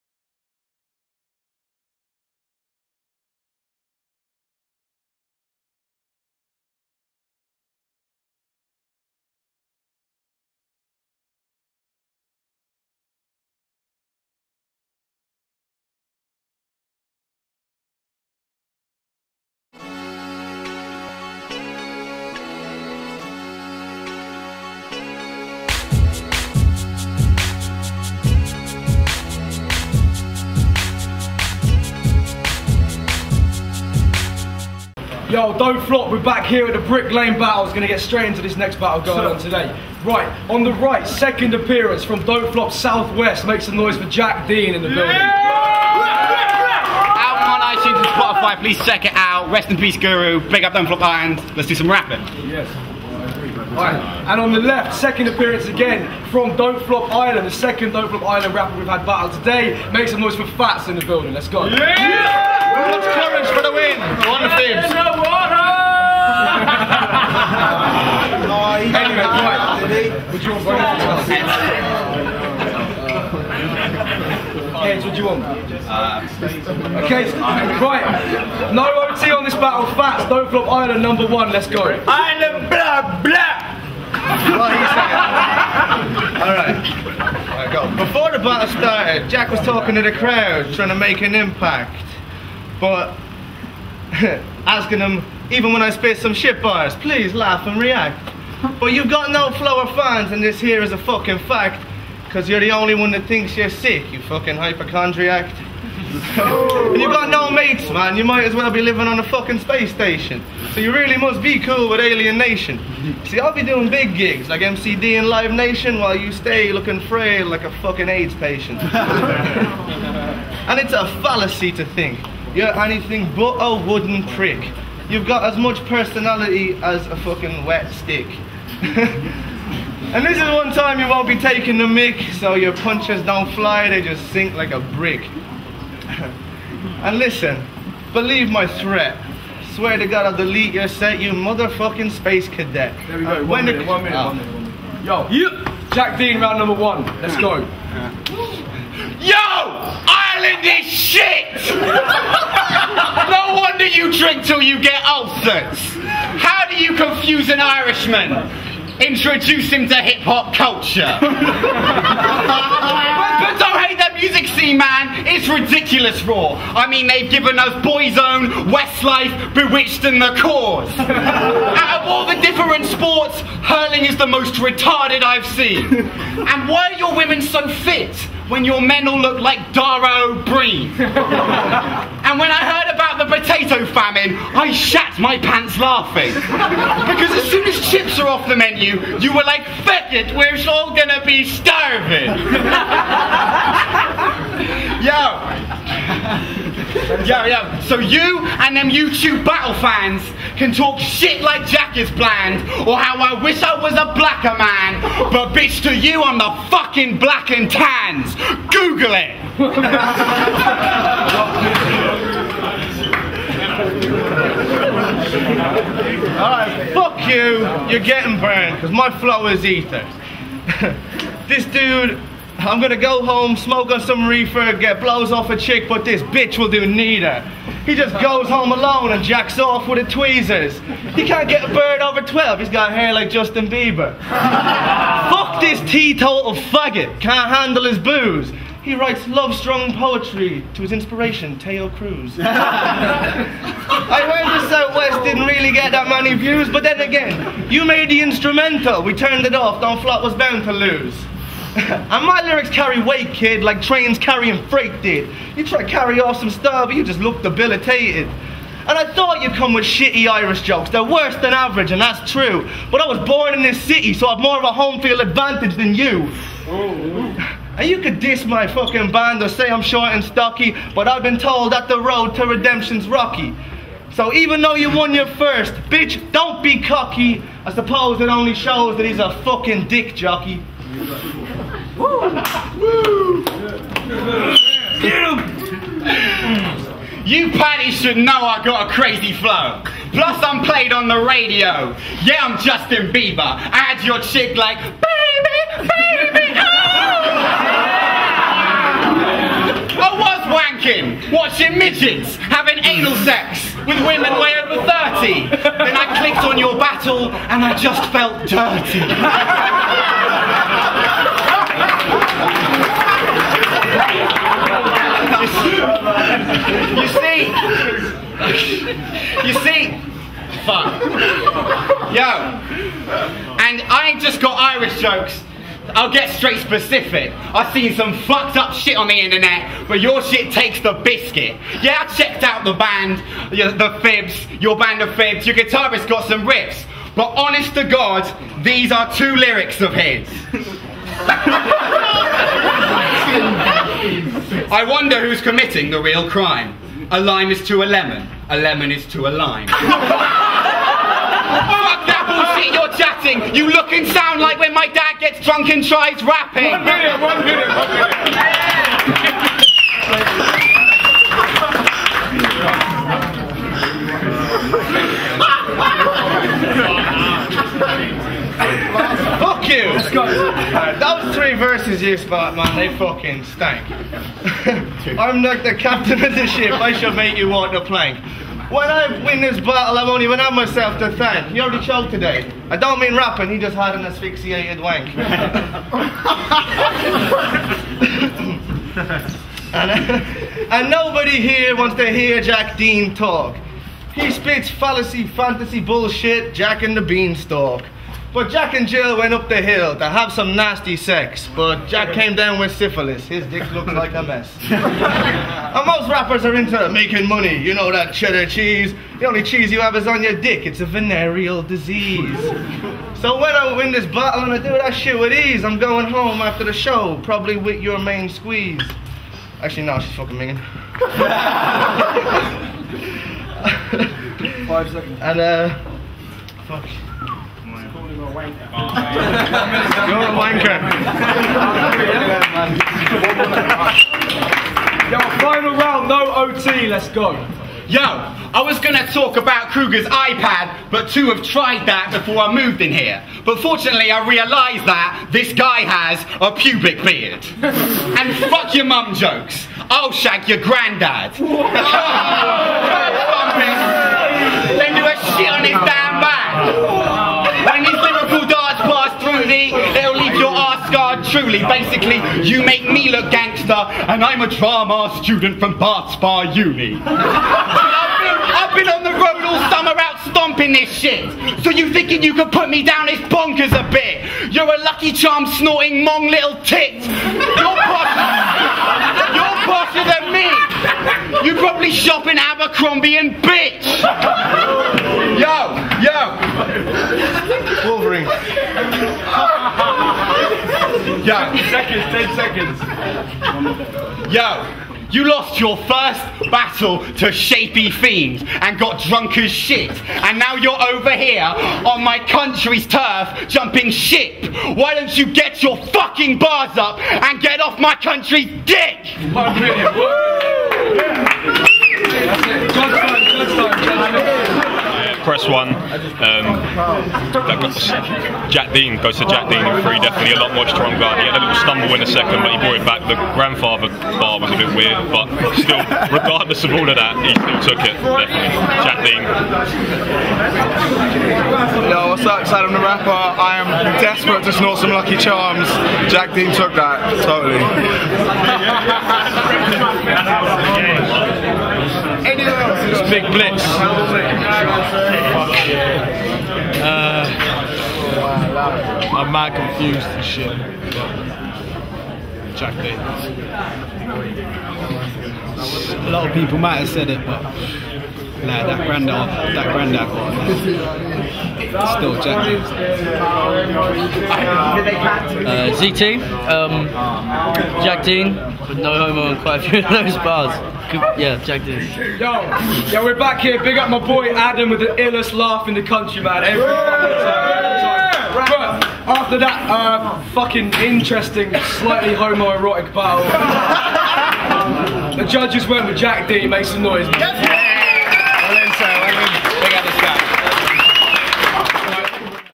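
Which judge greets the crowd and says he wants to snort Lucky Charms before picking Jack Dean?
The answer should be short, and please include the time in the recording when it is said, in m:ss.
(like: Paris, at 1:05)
Saddam the Rapper, at 8:52.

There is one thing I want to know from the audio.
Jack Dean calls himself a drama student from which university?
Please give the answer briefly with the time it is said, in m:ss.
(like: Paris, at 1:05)
Bath Spa Uni, at 7:45.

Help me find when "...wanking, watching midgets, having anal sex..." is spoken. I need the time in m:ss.
5:00.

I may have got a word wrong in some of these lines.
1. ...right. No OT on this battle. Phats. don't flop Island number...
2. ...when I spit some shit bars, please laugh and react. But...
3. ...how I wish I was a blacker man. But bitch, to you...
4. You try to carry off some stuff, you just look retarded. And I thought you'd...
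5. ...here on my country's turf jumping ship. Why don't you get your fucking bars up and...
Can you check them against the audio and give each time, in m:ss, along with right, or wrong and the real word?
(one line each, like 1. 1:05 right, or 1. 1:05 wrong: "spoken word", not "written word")
1. 1:17 right
2. 1:35 right
3. 3:22 right
4. 4:15 wrong: "debilitated", not "retarded"
5. 8:21 right.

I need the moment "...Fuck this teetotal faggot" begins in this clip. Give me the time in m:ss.
3:55.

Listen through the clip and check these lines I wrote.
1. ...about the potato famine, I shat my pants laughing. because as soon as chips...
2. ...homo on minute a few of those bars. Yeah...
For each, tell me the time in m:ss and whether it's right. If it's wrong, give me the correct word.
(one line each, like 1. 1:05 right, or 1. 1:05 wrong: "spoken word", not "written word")
1. 3:02 right
2. 9:28 wrong: "quite", not "minute".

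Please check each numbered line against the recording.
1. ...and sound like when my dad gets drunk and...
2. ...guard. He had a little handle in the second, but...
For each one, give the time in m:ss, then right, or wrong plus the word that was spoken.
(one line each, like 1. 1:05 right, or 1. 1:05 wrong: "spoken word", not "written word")
1. 5:53 right
2. 8:40 wrong: "stumble", not "handle".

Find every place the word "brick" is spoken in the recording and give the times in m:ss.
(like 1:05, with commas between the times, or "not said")
0:36, 2:14.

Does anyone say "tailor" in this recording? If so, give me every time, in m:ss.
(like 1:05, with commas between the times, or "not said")
not said.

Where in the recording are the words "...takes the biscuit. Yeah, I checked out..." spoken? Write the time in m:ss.
5:30.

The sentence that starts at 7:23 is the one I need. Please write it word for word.
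But fortunately, I realised that this guy has a pubic beard.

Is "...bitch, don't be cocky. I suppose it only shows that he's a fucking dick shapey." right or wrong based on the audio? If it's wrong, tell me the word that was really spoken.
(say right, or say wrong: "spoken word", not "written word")
wrong: "jockey", not "shapey".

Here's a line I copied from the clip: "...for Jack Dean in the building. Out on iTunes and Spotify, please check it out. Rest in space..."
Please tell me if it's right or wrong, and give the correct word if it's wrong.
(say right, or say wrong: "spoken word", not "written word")
wrong: "peace", not "space".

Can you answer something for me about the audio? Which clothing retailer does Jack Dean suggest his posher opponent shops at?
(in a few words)
Abercrombie.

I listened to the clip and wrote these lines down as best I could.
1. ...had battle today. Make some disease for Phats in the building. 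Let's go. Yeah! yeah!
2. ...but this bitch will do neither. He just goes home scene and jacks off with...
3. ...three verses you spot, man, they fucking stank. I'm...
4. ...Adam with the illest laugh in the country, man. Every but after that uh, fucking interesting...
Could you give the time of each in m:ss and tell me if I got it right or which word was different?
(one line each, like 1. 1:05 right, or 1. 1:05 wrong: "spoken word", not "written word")
1. 0:58 wrong: "noise", not "disease"
2. 3:45 wrong: "alone", not "scene"
3. 6:11 right
4. 9:34 right.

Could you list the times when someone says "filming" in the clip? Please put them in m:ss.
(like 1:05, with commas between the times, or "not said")
not said.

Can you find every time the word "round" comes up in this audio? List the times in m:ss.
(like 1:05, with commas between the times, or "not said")
2:26, 7:15.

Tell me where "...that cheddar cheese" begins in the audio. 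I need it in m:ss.
6:47.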